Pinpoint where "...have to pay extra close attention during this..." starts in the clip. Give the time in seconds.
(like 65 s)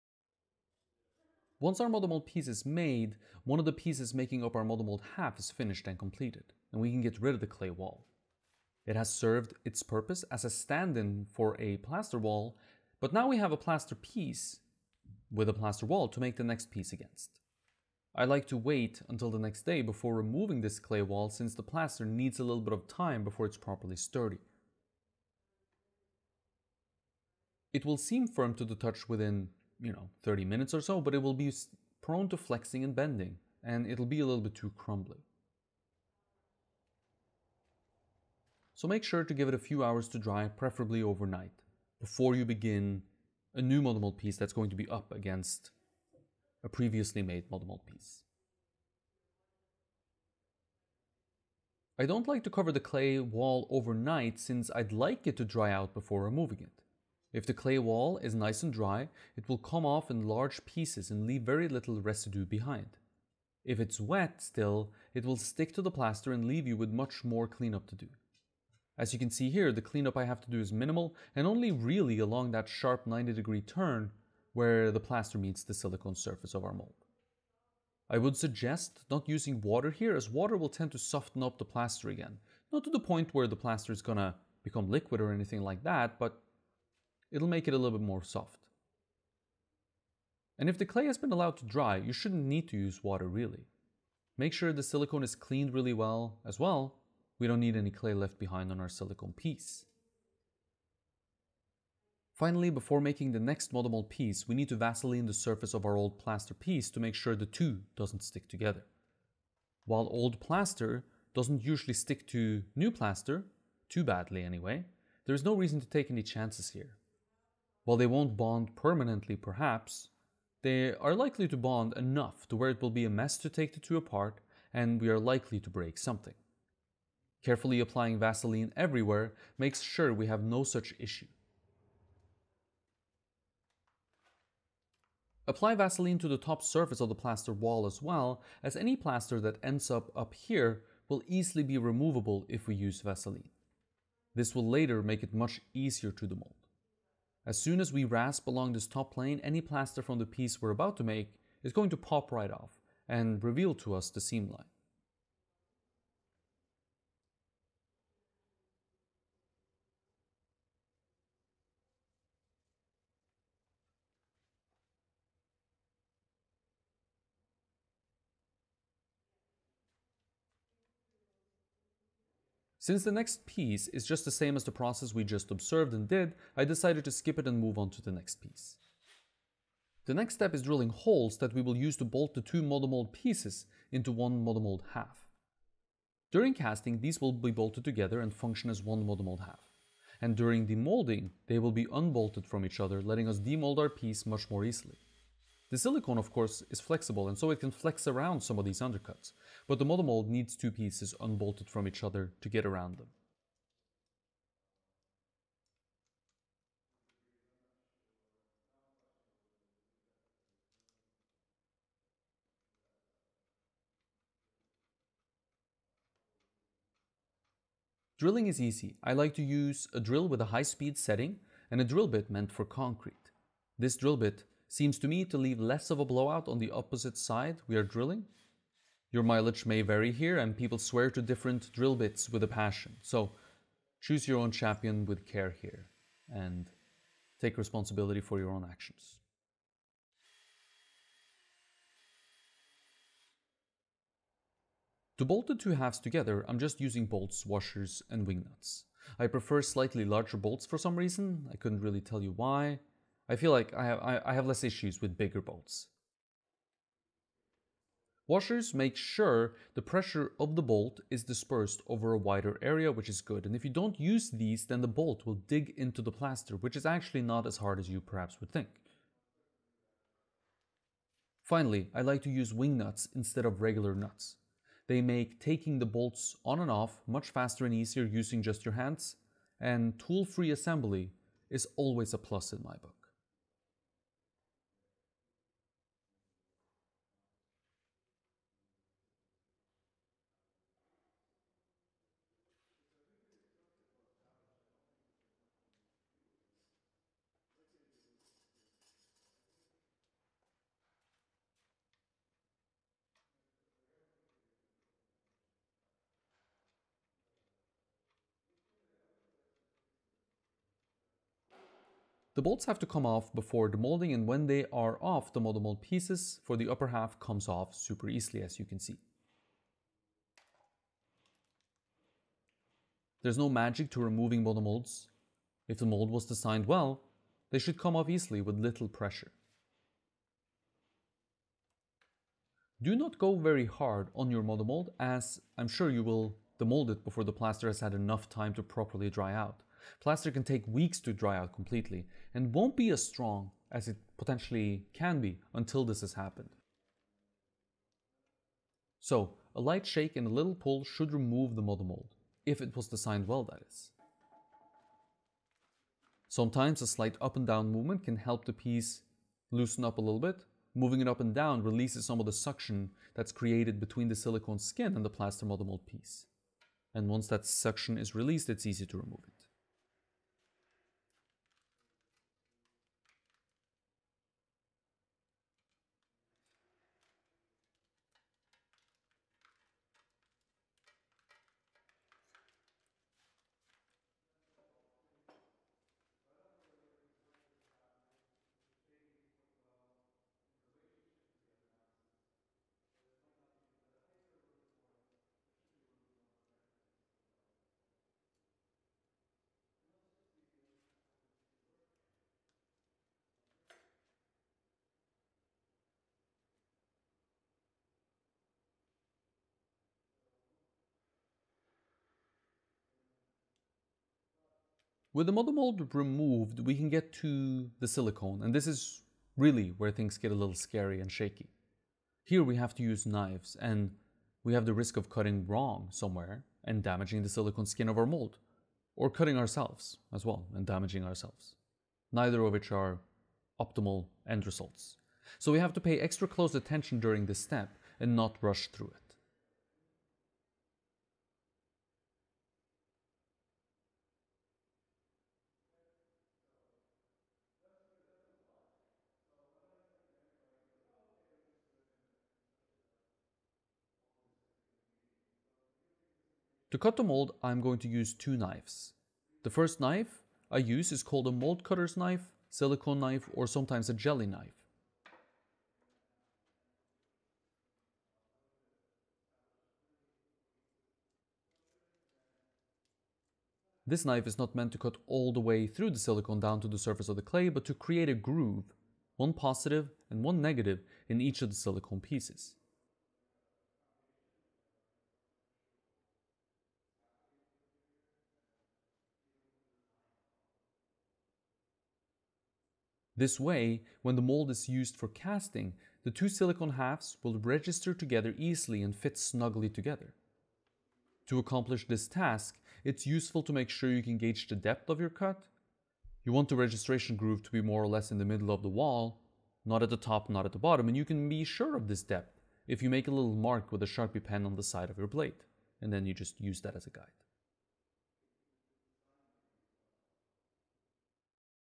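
435 s.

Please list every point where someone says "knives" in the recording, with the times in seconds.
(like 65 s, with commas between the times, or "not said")
423 s, 458 s.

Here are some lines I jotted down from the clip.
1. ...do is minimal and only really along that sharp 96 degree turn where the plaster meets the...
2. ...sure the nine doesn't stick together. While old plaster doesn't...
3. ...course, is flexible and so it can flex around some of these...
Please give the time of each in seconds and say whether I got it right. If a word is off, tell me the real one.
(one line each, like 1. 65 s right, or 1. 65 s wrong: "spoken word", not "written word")
1. 70 s wrong: "90", not "96"
2. 107 s wrong: "two", not "nine"
3. 196 s right.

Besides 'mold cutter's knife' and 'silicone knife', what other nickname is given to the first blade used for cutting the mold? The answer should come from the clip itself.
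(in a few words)
jelly knife.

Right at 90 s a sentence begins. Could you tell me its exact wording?
And if the clay has been allowed to dry, you shouldn't need to use water really.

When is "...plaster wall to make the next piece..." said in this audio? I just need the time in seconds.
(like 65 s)
15 s.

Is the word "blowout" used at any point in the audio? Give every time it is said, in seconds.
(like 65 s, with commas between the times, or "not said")
226 s.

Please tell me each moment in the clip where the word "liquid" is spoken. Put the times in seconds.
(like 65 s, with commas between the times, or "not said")
84 s.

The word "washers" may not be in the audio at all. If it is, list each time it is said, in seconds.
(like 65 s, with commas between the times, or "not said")
247 s, 258 s.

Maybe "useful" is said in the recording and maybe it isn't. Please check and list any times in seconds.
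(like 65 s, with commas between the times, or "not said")
503 s.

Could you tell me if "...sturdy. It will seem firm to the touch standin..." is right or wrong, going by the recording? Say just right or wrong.
wrong.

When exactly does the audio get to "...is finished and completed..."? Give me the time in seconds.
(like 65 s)
5 s.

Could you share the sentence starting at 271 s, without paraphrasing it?
Finally, I like to use wing nuts instead of regular nuts.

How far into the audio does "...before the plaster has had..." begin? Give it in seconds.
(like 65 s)
337 s.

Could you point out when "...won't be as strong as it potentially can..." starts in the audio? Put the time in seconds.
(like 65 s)
342 s.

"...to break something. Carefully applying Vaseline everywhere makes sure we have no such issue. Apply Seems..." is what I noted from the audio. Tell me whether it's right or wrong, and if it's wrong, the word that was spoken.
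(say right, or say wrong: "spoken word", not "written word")
wrong: "Vaseline", not "Seems".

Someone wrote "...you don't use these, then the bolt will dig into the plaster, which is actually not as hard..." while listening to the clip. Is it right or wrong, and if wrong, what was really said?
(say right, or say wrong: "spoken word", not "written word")
right.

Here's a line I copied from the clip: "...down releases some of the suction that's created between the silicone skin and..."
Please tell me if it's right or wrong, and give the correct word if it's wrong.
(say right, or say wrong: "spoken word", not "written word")
right.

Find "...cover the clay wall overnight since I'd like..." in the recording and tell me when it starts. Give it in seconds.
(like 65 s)
52 s.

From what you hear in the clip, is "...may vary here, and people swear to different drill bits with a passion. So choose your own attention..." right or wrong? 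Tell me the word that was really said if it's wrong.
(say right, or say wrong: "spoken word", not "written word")
wrong: "champion", not "attention".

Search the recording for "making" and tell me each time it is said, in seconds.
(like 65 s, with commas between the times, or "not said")
4 s, 103 s.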